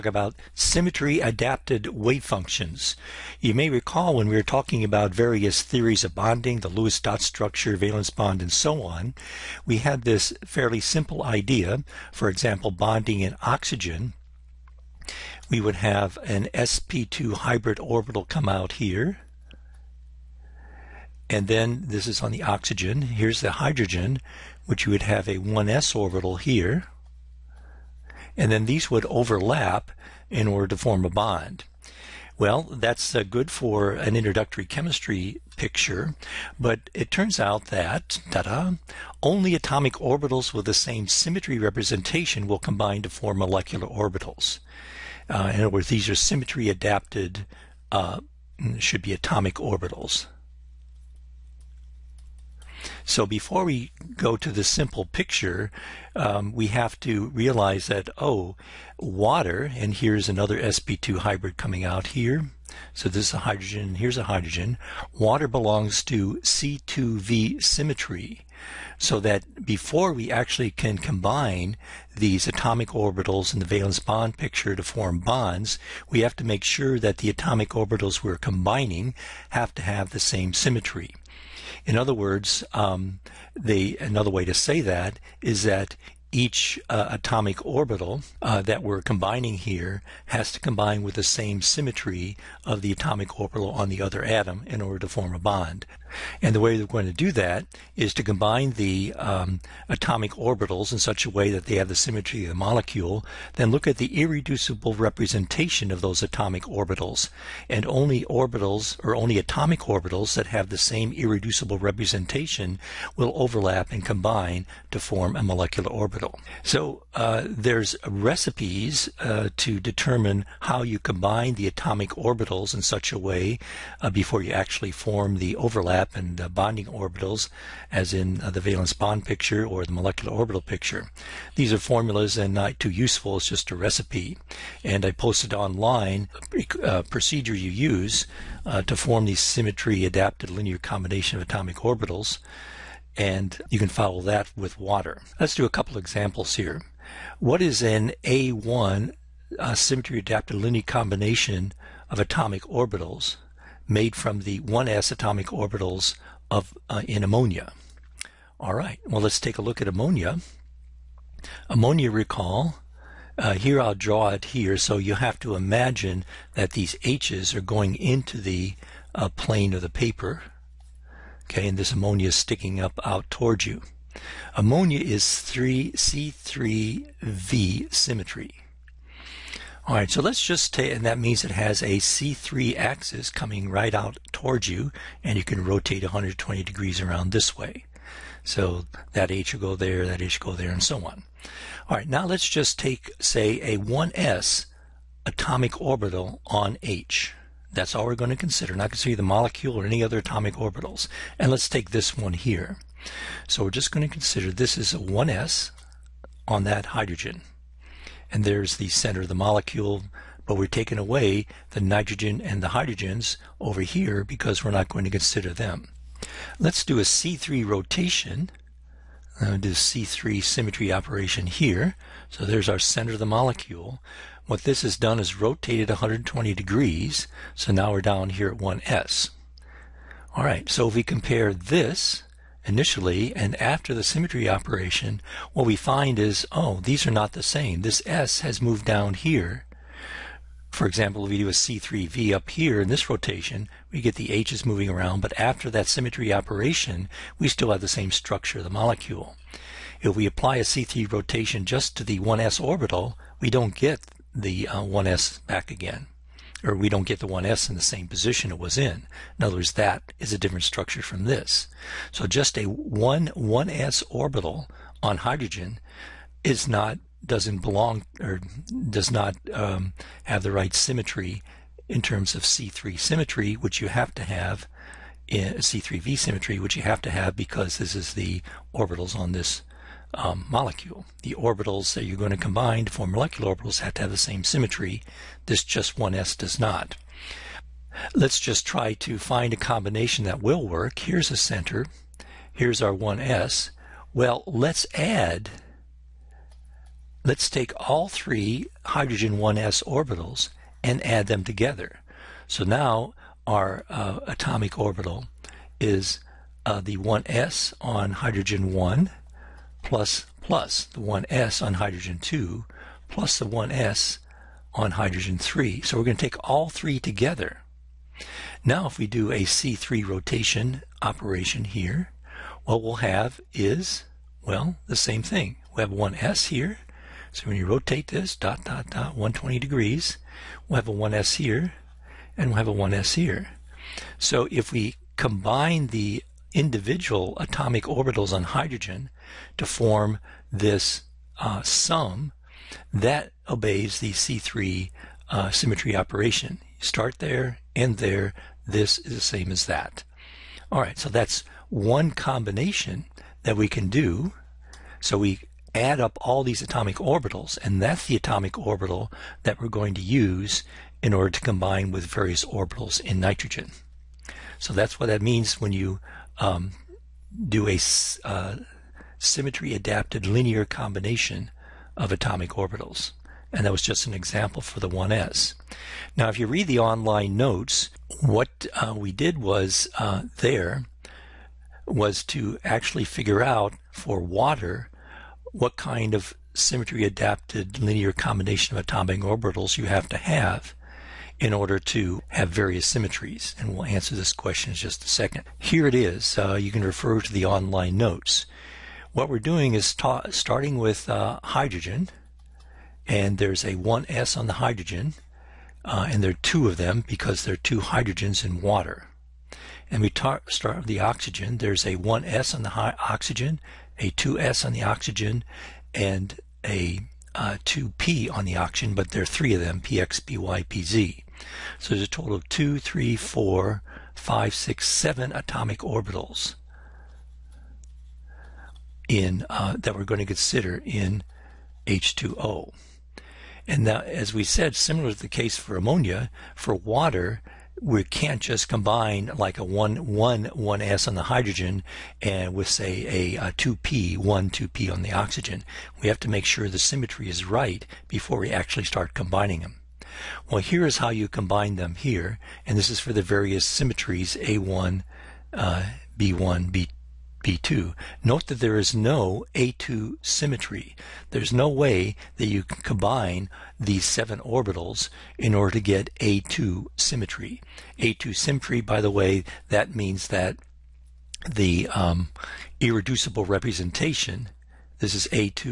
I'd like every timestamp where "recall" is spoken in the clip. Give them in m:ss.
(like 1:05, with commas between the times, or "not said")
0:03, 2:42.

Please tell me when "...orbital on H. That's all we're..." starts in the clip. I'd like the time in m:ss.
3:15.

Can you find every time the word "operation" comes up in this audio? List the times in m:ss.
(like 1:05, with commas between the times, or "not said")
3:40, 3:54, 4:06, 5:21, 5:45.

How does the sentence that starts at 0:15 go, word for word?
We would have an sp2 hybrid orbital come out here.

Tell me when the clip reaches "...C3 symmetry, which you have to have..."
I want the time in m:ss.
4:32.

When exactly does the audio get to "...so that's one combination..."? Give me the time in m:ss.
5:50.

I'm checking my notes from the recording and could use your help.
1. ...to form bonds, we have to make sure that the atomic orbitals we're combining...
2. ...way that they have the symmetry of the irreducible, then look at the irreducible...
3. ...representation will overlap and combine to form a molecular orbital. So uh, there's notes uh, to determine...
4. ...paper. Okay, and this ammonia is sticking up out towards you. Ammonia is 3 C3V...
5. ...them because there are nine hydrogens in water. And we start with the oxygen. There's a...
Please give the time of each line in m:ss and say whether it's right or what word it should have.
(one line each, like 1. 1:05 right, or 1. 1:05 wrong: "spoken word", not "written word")
1. 1:14 right
2. 1:41 wrong: "molecule", not "irreducible"
3. 1:51 wrong: "recipes", not "notes"
4. 2:49 right
5. 6:46 wrong: "two", not "nine".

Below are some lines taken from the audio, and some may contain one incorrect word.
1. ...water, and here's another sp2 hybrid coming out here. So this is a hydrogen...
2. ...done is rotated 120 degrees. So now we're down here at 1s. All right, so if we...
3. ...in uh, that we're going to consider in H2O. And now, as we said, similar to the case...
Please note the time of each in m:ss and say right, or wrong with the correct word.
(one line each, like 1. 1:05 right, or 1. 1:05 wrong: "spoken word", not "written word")
1. 0:58 right
2. 3:44 right
3. 7:09 right.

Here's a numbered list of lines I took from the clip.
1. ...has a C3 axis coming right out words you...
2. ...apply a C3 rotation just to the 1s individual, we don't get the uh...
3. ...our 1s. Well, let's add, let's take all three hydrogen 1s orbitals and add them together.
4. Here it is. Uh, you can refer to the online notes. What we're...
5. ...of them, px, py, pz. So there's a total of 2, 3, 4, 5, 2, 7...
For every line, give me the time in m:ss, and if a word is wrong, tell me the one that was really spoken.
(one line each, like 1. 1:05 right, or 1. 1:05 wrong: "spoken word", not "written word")
1. 3:01 wrong: "towards", not "words"
2. 4:10 wrong: "orbital", not "individual"
3. 4:52 right
4. 6:35 right
5. 6:59 wrong: "6", not "2".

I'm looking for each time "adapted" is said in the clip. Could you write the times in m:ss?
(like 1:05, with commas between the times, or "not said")
0:01, 0:46, 2:20, 2:30, 6:09, 6:27.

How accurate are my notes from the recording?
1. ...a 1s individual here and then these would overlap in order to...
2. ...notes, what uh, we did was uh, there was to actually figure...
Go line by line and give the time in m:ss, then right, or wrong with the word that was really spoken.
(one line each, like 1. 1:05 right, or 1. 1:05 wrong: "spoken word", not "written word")
1. 0:25 wrong: "orbital", not "individual"
2. 6:17 right.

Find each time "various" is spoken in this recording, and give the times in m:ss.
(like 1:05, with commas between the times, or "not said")
0:05, 6:02, 6:32, 7:33.